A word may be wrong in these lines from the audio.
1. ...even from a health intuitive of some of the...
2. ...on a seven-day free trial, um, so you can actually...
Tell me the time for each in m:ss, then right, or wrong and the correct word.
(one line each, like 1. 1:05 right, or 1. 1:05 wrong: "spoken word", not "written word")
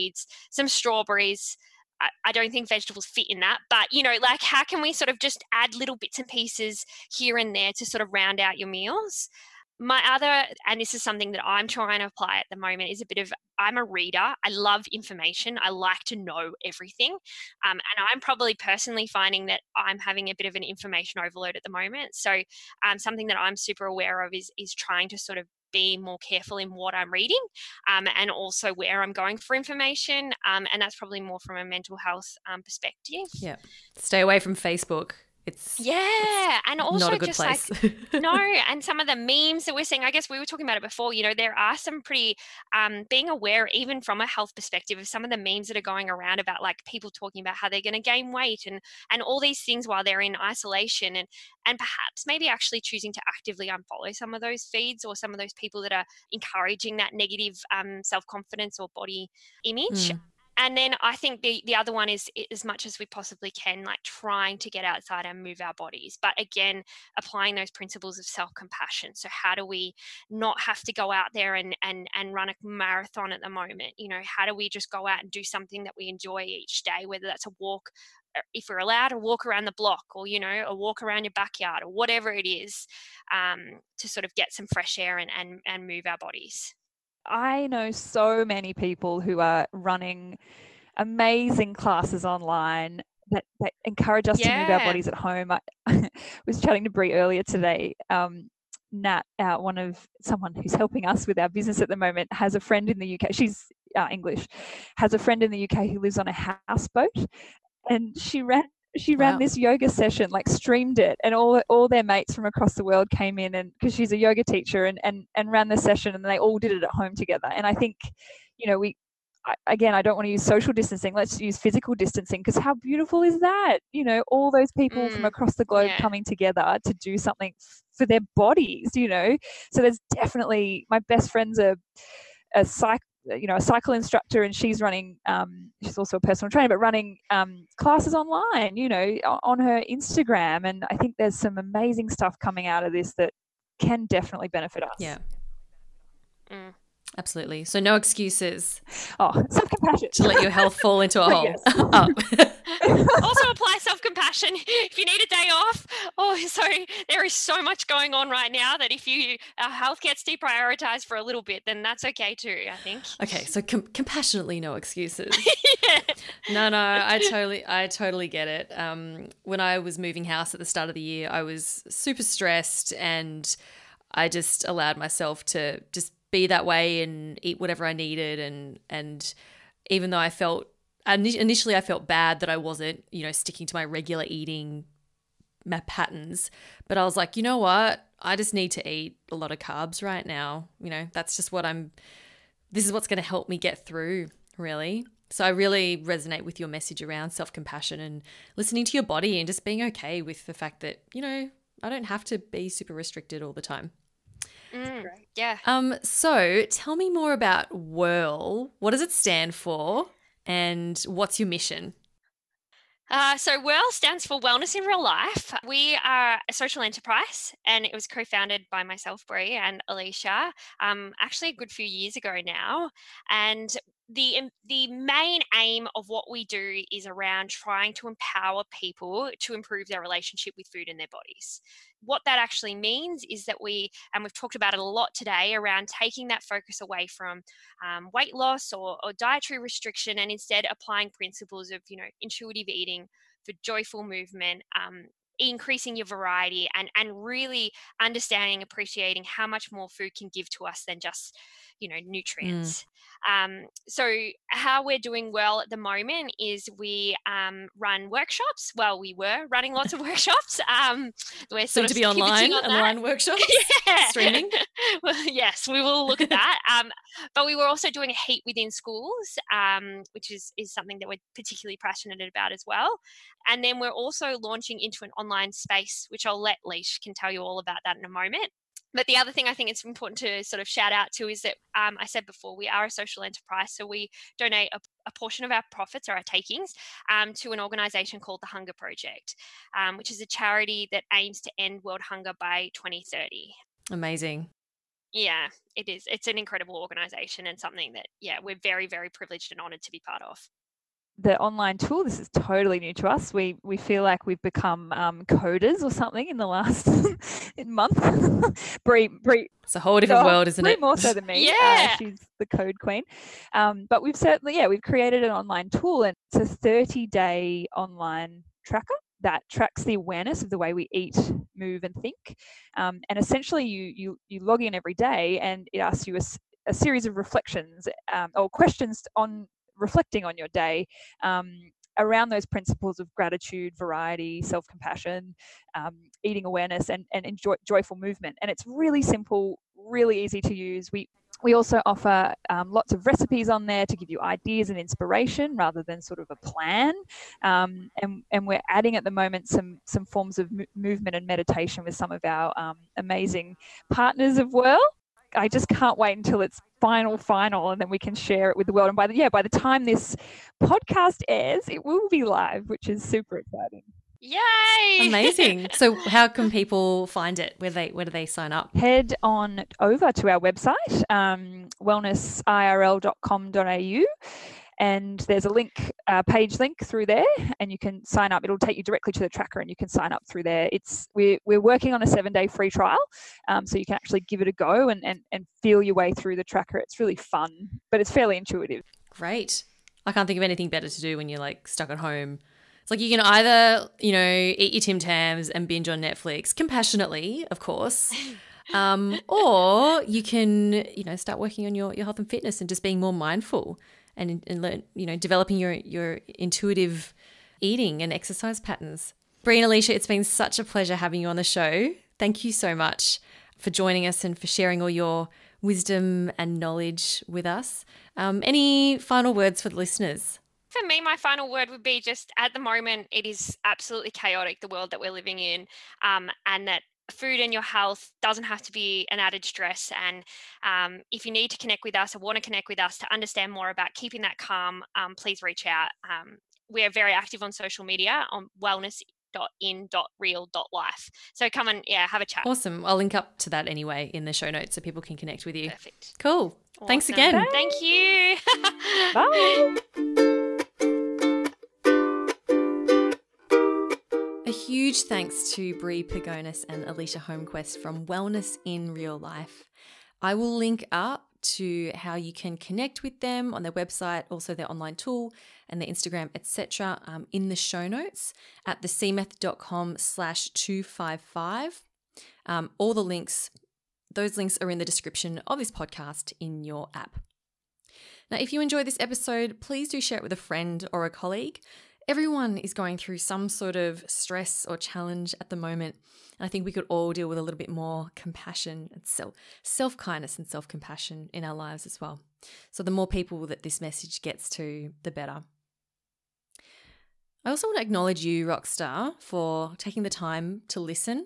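1. 0:43 wrong: "perspective", not "intuitive"
2. 6:21 right.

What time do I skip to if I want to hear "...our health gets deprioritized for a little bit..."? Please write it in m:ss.
2:39.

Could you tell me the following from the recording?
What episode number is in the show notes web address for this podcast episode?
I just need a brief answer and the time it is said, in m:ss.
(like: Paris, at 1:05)
255, at 7:50.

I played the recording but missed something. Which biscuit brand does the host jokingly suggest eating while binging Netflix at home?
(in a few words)
Tim Tams.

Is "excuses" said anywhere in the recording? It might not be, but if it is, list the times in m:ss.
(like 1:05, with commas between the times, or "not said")
2:27, 2:44.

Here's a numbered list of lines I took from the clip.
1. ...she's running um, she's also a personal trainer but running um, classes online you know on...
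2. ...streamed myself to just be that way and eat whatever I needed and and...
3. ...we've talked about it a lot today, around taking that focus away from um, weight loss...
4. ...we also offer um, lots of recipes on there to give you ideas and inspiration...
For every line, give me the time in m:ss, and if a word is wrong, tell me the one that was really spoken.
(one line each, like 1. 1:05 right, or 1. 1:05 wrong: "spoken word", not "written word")
1. 2:14 right
2. 2:54 wrong: "allowed", not "streamed"
3. 3:54 right
4. 5:41 right.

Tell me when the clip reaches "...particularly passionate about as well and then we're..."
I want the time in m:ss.
4:31.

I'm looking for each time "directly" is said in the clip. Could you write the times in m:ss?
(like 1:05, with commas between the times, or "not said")
6:18.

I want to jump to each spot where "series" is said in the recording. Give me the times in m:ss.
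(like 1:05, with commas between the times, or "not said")
5:26.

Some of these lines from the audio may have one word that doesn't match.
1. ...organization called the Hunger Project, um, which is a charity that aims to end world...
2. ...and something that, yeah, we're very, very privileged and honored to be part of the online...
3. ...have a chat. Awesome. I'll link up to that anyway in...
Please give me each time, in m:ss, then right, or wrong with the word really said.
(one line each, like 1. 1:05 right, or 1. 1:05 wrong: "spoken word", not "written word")
1. 4:47 right
2. 4:57 right
3. 7:22 right.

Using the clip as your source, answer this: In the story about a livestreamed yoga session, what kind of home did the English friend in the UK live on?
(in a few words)
houseboat.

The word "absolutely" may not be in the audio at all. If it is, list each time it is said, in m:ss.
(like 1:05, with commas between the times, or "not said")
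2:27, 7:03.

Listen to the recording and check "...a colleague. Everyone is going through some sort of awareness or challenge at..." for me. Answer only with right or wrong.
wrong.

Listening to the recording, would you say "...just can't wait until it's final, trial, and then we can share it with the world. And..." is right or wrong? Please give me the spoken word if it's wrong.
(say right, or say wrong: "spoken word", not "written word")
wrong: "final", not "trial".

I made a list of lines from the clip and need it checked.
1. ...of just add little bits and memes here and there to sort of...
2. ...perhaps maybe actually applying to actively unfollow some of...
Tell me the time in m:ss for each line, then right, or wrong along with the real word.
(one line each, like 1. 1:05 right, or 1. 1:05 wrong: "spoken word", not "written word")
1. 0:05 wrong: "pieces", not "memes"
2. 0:51 wrong: "choosing", not "applying".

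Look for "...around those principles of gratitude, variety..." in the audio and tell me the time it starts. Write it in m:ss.
5:31.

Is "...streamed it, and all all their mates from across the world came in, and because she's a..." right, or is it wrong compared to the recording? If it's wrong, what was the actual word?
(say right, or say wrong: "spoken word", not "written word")
right.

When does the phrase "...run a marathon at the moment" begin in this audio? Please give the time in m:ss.
1:12.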